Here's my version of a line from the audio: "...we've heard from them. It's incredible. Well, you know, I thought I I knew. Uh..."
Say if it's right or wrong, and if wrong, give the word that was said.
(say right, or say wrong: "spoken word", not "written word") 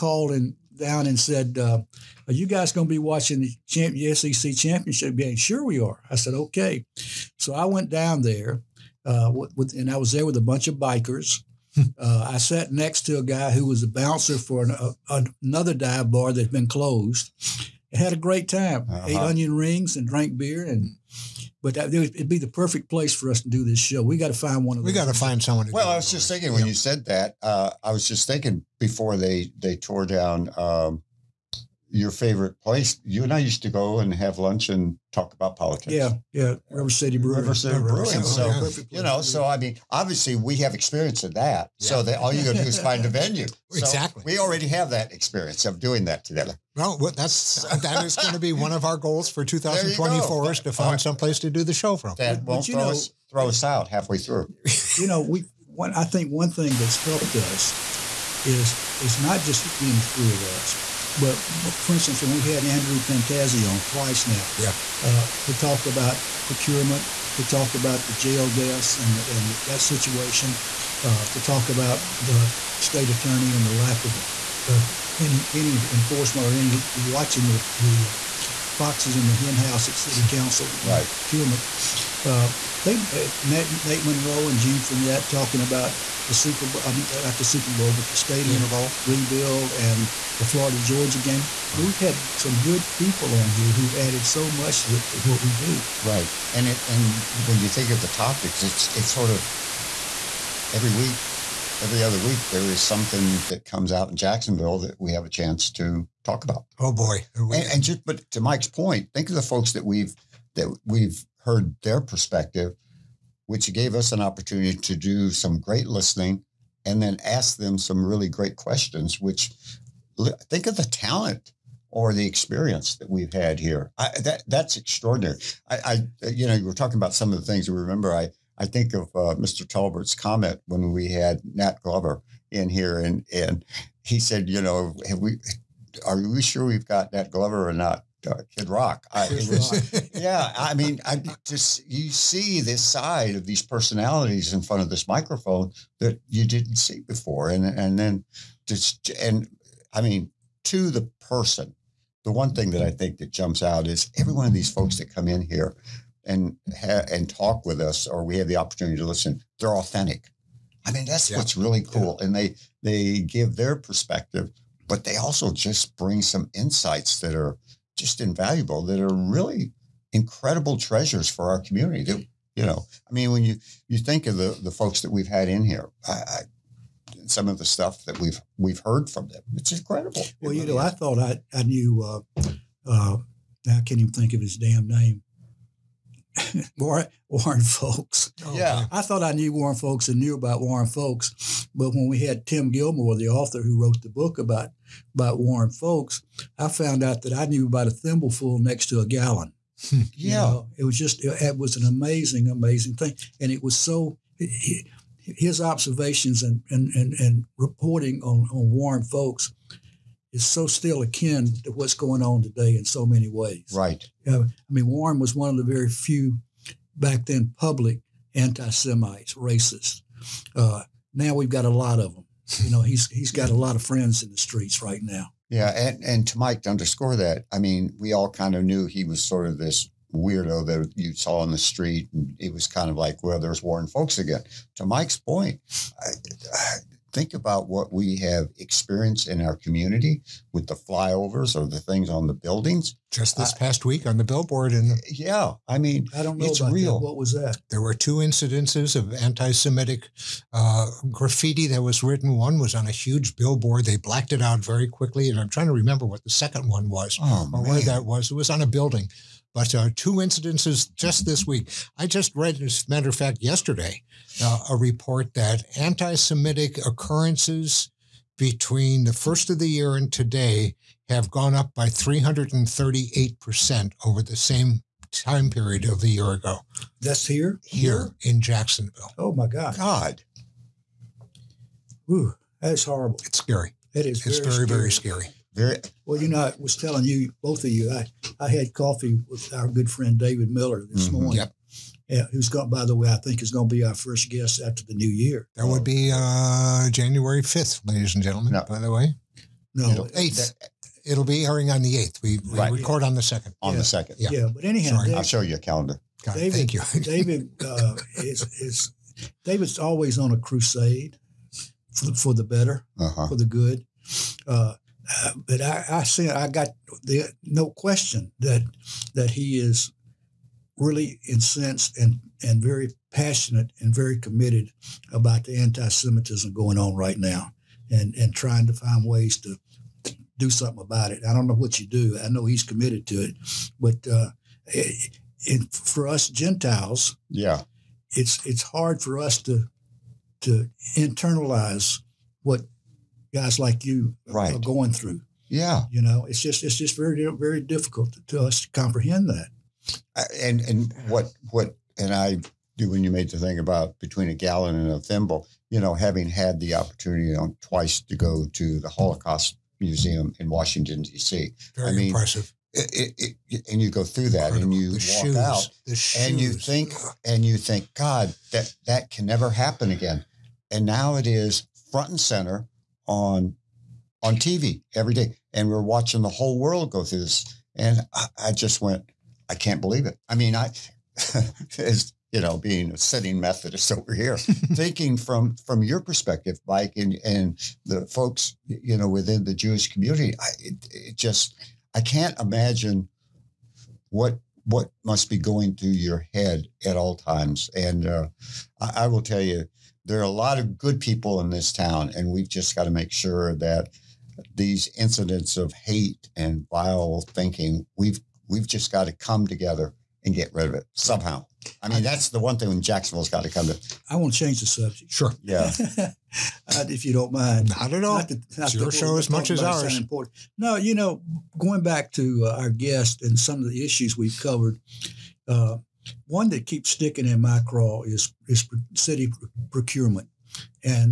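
right.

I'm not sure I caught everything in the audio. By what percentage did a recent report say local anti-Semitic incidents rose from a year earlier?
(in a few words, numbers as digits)
338%.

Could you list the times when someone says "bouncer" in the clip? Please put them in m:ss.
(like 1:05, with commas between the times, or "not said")
0:13.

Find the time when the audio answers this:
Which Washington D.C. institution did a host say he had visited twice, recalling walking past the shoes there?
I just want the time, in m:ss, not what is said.
5:58.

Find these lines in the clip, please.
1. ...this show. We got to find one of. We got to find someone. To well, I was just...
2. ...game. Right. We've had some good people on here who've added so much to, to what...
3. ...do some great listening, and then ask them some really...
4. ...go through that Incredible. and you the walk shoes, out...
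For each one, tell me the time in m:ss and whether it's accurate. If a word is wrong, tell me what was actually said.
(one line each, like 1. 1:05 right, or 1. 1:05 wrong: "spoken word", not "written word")
1. 0:23 right
2. 1:31 right
3. 1:54 right
4. 6:03 right.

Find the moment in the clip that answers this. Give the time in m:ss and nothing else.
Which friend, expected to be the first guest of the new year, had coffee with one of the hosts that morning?
4:50.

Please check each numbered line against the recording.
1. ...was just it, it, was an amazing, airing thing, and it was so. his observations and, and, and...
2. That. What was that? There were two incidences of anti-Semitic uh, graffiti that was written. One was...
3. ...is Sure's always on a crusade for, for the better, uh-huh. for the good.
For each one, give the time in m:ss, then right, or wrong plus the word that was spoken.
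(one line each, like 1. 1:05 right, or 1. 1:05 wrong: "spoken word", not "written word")
1. 3:20 wrong: "amazing", not "airing"
2. 4:06 right
3. 5:08 wrong: "David", not "Sure".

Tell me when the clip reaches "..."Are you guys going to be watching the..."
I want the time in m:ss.
0:02.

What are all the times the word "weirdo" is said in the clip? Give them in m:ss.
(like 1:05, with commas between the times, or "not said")
3:50.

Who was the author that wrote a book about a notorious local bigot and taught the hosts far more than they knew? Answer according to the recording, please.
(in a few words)
Tim Gilmore.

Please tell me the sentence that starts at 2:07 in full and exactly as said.
we Remember I I think of uh, Mr.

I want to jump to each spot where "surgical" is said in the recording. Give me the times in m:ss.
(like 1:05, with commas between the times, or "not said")
not said.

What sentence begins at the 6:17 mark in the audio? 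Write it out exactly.
And I, I just went, I can't believe it.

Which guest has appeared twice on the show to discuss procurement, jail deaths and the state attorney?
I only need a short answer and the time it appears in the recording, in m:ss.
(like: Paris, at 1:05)
Andrew Pantazi, at 1:02.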